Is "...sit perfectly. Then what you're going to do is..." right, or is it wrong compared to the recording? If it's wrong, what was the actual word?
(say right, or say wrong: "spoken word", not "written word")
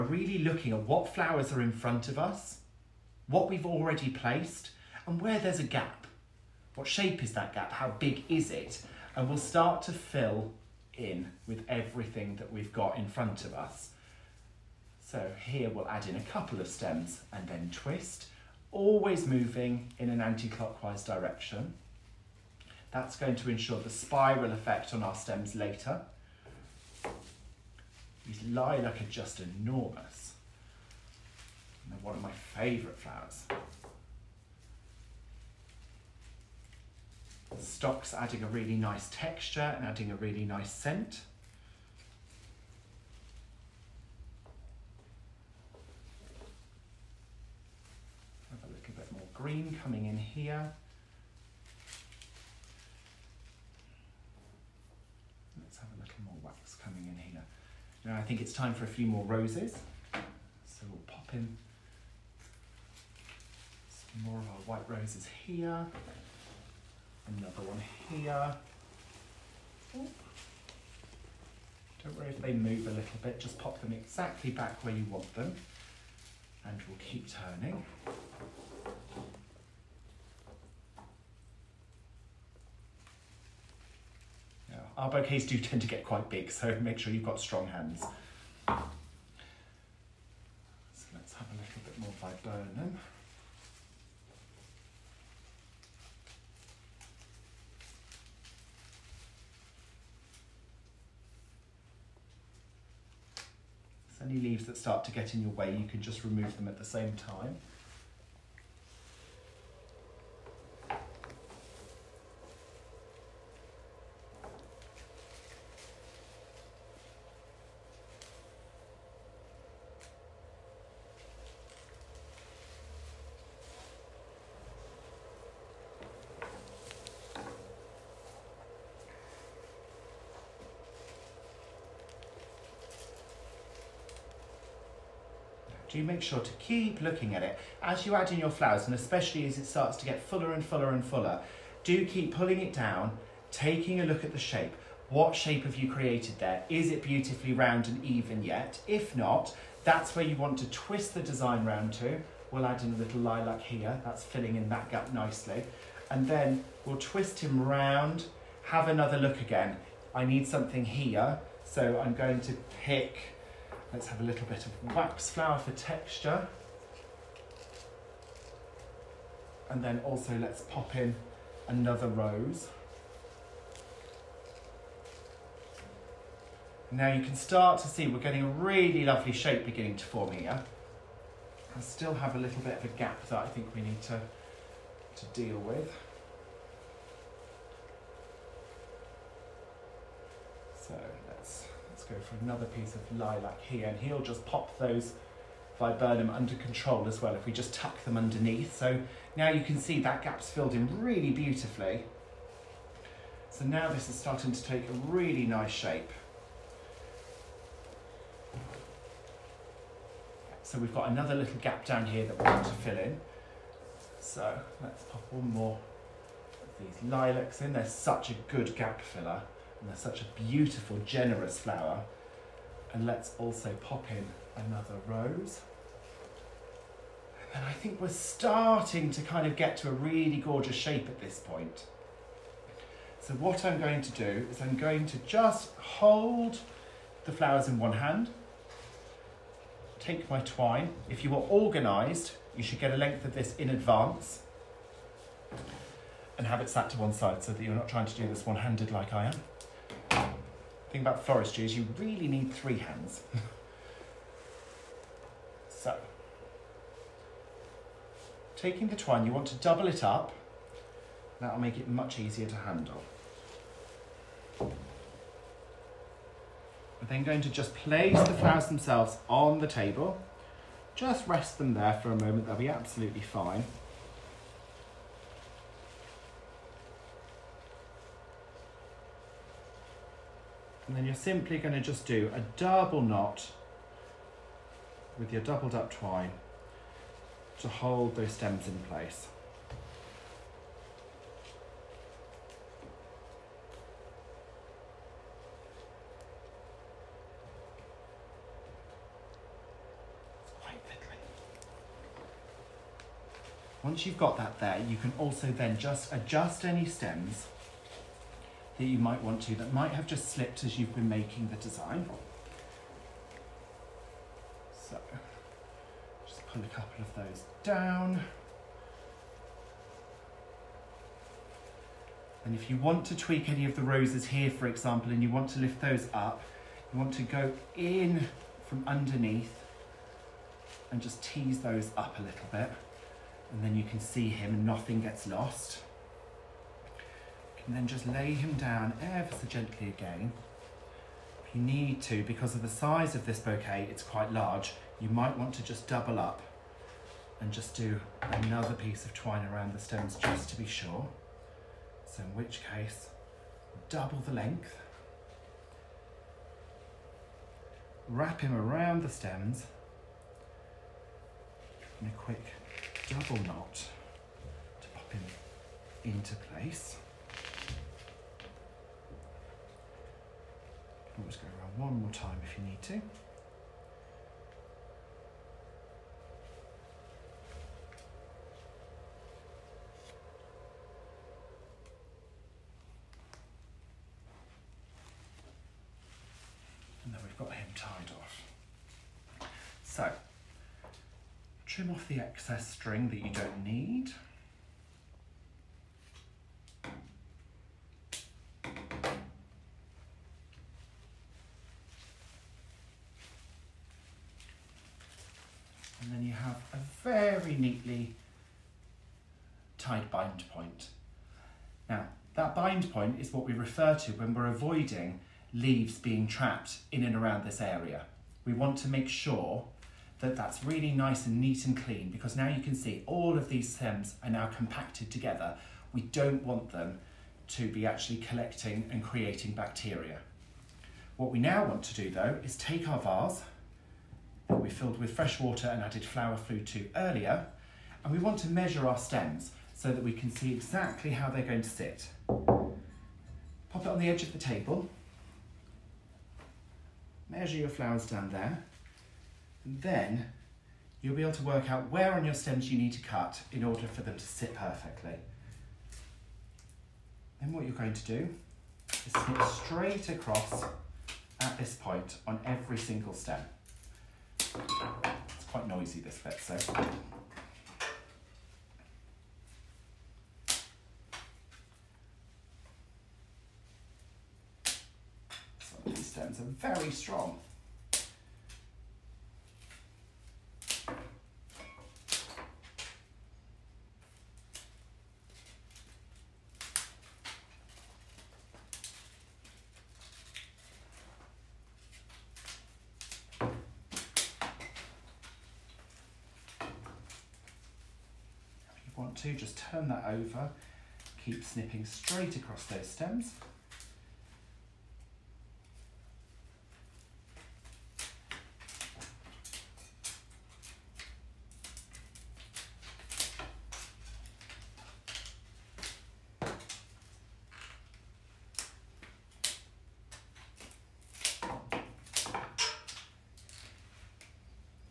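right.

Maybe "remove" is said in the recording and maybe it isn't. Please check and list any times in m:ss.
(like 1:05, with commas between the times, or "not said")
1:46.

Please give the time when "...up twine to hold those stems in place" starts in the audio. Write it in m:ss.
4:45.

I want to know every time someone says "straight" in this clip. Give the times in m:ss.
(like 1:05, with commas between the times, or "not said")
7:39, 8:21.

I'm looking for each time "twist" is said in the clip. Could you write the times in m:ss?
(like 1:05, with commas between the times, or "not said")
0:17, 2:30, 2:36.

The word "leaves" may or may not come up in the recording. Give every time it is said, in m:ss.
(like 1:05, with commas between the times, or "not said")
1:44, 6:55.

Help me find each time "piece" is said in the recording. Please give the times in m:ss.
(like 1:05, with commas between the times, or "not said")
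3:12, 5:48.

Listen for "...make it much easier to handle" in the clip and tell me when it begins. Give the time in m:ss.
4:21.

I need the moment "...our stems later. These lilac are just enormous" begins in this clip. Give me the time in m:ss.
0:25.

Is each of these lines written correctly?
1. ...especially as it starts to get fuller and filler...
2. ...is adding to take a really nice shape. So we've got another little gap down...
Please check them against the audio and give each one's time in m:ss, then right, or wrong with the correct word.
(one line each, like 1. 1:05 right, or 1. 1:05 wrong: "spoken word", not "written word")
1. 2:18 wrong: "fuller", not "filler"
2. 3:24 wrong: "starting", not "adding".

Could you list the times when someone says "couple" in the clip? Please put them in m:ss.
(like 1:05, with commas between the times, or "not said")
0:16, 5:16.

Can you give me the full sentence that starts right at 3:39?
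And are such a beautiful, generous flower.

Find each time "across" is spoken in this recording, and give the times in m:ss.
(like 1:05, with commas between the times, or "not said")
7:40, 8:22.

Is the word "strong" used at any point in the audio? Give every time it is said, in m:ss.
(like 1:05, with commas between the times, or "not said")
1:27, 7:56.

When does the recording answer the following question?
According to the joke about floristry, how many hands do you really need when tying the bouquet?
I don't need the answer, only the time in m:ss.
4:12.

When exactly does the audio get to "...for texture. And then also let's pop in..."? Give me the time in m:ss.
2:45.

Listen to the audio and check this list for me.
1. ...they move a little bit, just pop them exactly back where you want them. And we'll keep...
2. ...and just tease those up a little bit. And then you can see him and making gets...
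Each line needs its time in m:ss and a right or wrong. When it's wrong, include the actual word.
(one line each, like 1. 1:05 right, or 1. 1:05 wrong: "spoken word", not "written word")
1. 1:12 right
2. 5:30 wrong: "nothing", not "making".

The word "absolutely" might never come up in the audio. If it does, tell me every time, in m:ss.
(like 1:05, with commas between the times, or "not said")
4:32.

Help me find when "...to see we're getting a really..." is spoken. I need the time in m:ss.
2:57.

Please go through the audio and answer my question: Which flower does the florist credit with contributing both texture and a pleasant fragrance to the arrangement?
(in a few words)
Stock.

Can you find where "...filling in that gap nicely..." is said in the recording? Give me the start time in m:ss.
2:34.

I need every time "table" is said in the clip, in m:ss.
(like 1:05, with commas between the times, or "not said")
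4:29, 7:24.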